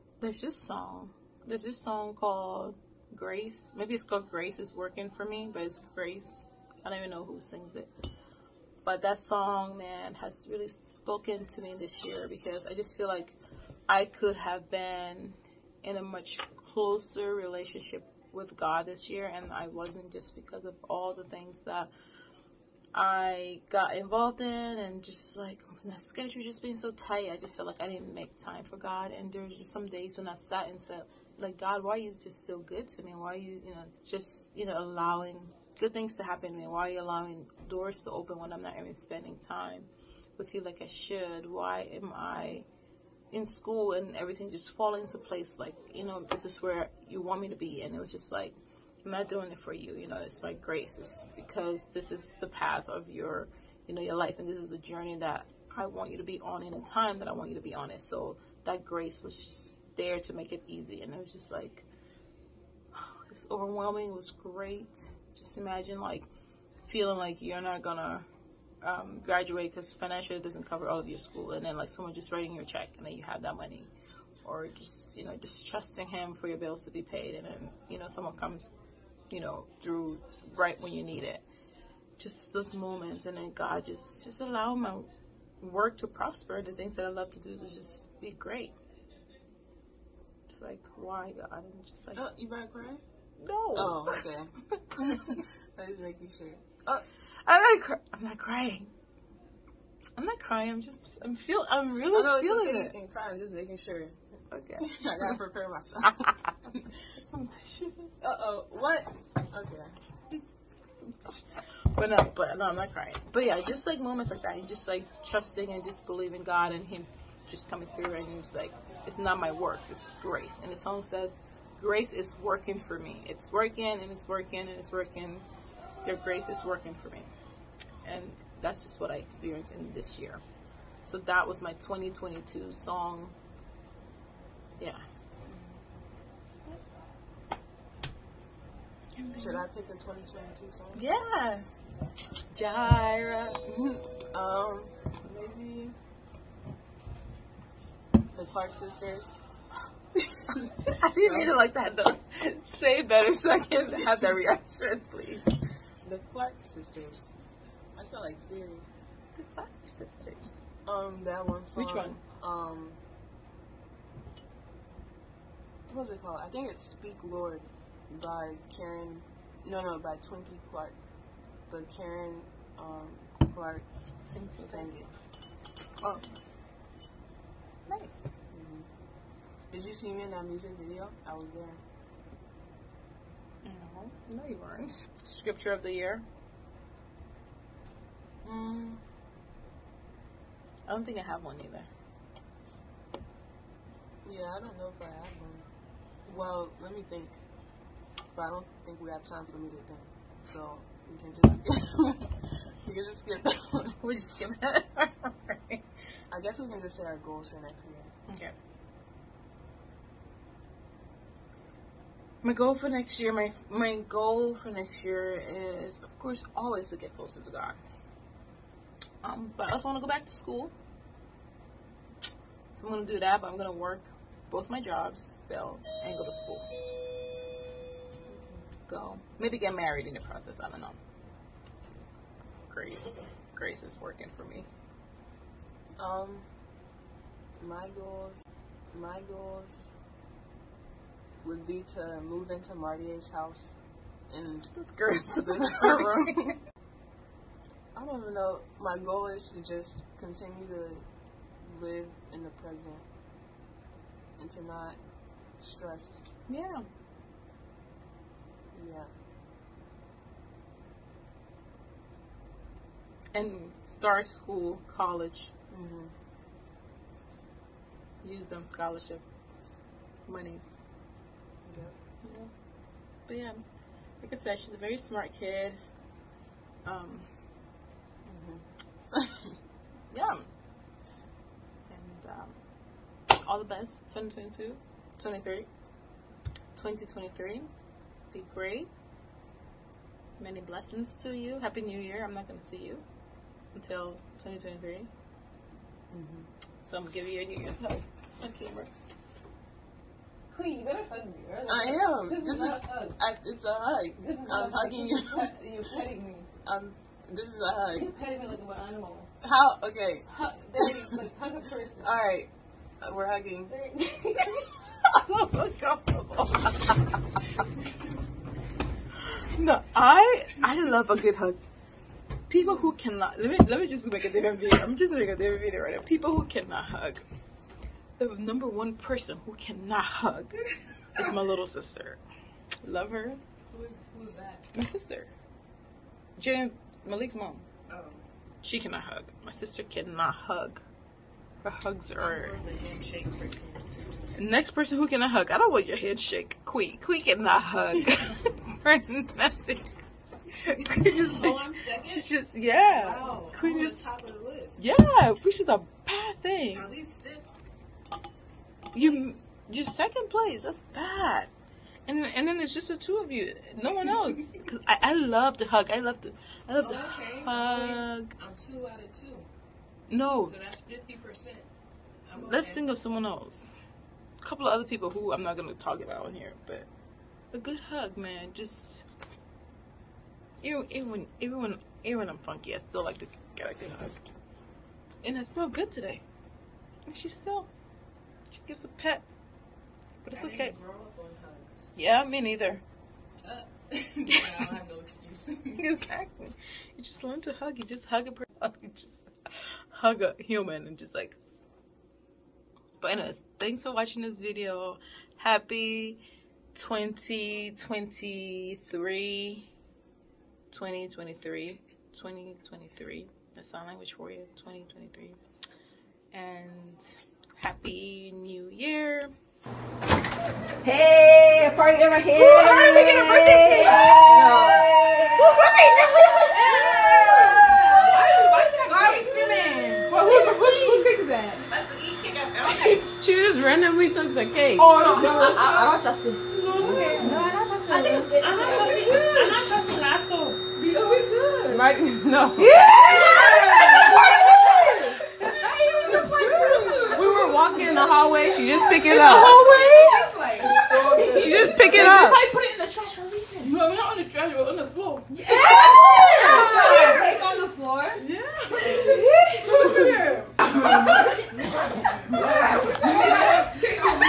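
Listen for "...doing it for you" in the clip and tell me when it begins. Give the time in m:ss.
0:49.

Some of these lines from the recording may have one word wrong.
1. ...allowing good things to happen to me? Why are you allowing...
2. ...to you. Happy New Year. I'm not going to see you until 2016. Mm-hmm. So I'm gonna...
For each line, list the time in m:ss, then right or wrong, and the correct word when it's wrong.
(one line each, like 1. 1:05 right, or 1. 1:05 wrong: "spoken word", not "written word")
1. 0:34 right
2. 4:51 wrong: "2023", not "2016".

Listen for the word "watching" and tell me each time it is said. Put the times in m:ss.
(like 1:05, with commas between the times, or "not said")
6:43.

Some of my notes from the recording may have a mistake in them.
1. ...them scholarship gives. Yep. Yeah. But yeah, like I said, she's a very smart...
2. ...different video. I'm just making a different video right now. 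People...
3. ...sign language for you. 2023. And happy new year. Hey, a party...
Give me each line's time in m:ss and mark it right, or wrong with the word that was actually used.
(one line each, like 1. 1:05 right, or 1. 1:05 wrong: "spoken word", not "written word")
1. 4:28 wrong: "monies", not "gives"
2. 5:24 right
3. 6:53 right.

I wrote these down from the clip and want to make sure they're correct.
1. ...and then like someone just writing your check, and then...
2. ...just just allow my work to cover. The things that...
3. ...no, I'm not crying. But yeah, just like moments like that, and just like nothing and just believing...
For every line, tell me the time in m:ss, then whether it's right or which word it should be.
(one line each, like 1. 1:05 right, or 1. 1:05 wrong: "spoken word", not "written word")
1. 1:11 right
2. 1:23 wrong: "prosper", not "cover"
3. 1:52 wrong: "trusting", not "nothing".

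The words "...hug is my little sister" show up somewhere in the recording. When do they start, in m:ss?
5:30.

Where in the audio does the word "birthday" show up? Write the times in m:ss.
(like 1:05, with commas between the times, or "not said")
7:03, 7:12.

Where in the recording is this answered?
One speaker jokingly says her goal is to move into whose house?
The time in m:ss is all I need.
4:02.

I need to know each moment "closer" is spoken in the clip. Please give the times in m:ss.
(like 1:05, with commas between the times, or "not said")
0:16, 3:37.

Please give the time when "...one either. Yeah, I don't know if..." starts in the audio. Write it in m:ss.
3:11.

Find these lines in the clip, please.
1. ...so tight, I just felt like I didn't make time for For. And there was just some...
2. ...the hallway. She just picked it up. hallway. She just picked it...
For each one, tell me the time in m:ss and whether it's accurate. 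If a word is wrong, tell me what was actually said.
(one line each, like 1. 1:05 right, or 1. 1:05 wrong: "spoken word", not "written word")
1. 0:26 wrong: "God", not "For"
2. 7:27 right.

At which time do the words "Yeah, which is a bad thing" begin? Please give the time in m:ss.
5:54.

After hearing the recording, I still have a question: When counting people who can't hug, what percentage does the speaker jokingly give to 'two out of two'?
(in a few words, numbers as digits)
50 percent.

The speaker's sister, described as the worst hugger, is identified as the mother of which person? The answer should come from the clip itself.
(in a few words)
Jen Malik.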